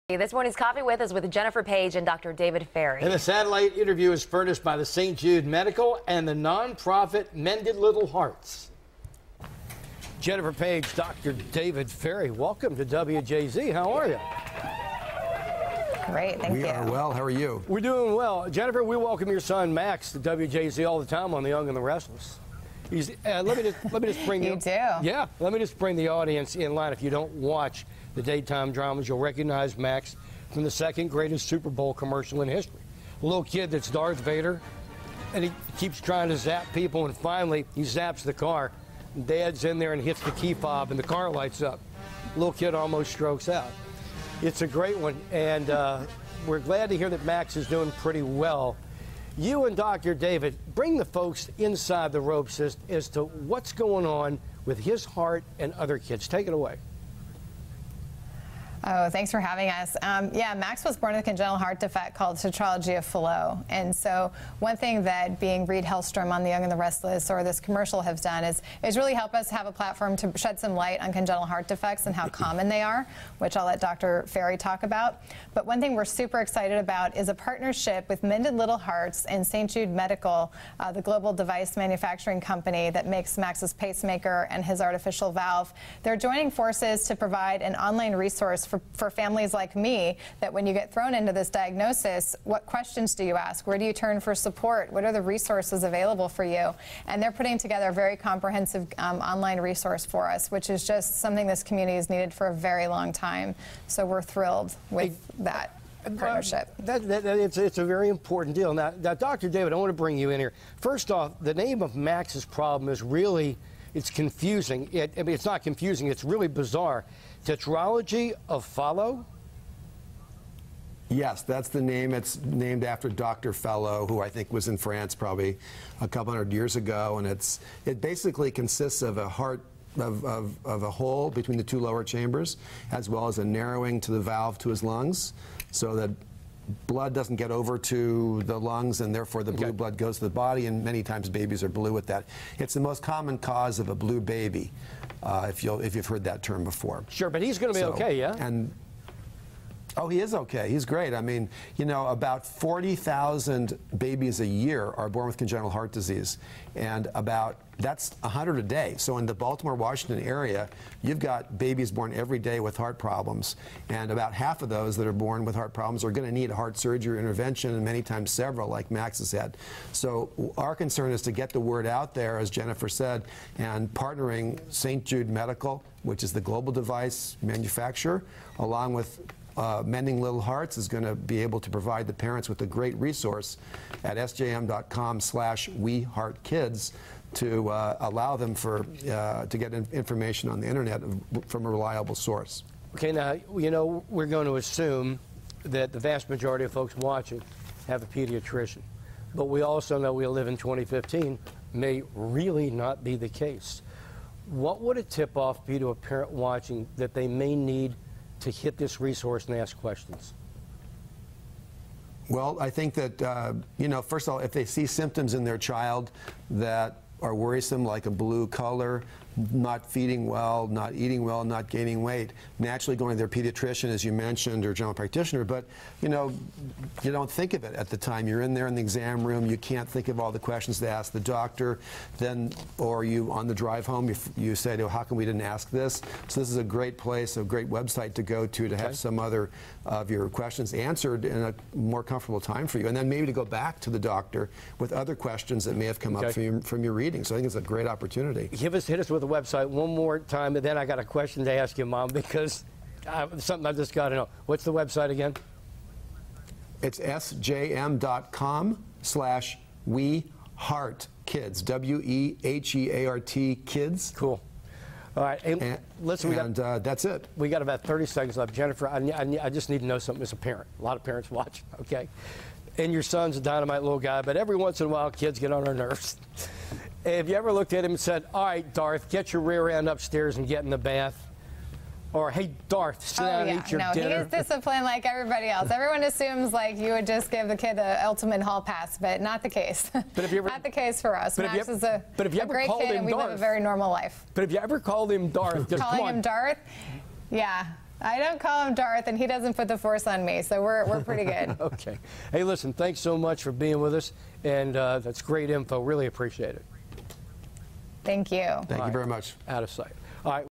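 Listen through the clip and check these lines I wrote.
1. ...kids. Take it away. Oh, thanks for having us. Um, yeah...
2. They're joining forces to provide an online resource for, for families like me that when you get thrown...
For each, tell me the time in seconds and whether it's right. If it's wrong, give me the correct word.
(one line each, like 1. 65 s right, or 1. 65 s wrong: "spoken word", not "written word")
1. 55 s right
2. 86 s right.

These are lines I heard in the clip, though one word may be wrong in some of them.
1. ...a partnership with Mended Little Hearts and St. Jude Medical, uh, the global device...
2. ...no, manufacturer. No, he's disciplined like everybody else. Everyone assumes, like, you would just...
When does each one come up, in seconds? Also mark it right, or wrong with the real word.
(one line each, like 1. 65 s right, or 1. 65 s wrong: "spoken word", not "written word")
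1. 77 s right
2. 283 s wrong: "dinner", not "manufacturer".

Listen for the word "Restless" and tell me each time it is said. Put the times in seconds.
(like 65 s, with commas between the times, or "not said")
21 s, 66 s.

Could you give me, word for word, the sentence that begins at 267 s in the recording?
We got about 30 seconds left.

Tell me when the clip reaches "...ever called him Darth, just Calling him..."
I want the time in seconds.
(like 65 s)
294 s.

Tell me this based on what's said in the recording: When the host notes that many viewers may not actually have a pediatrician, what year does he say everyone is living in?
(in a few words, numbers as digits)
2015.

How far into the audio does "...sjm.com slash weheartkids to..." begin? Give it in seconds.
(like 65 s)
184 s.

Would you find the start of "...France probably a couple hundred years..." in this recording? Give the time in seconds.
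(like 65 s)
124 s.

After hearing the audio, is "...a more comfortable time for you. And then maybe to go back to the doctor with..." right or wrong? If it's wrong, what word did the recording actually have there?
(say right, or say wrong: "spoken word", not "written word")
right.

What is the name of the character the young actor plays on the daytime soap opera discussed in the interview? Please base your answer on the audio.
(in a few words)
Reed Hellstrom.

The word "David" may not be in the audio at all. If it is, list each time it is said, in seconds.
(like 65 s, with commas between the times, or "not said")
2 s, 11 s, 50 s, 109 s.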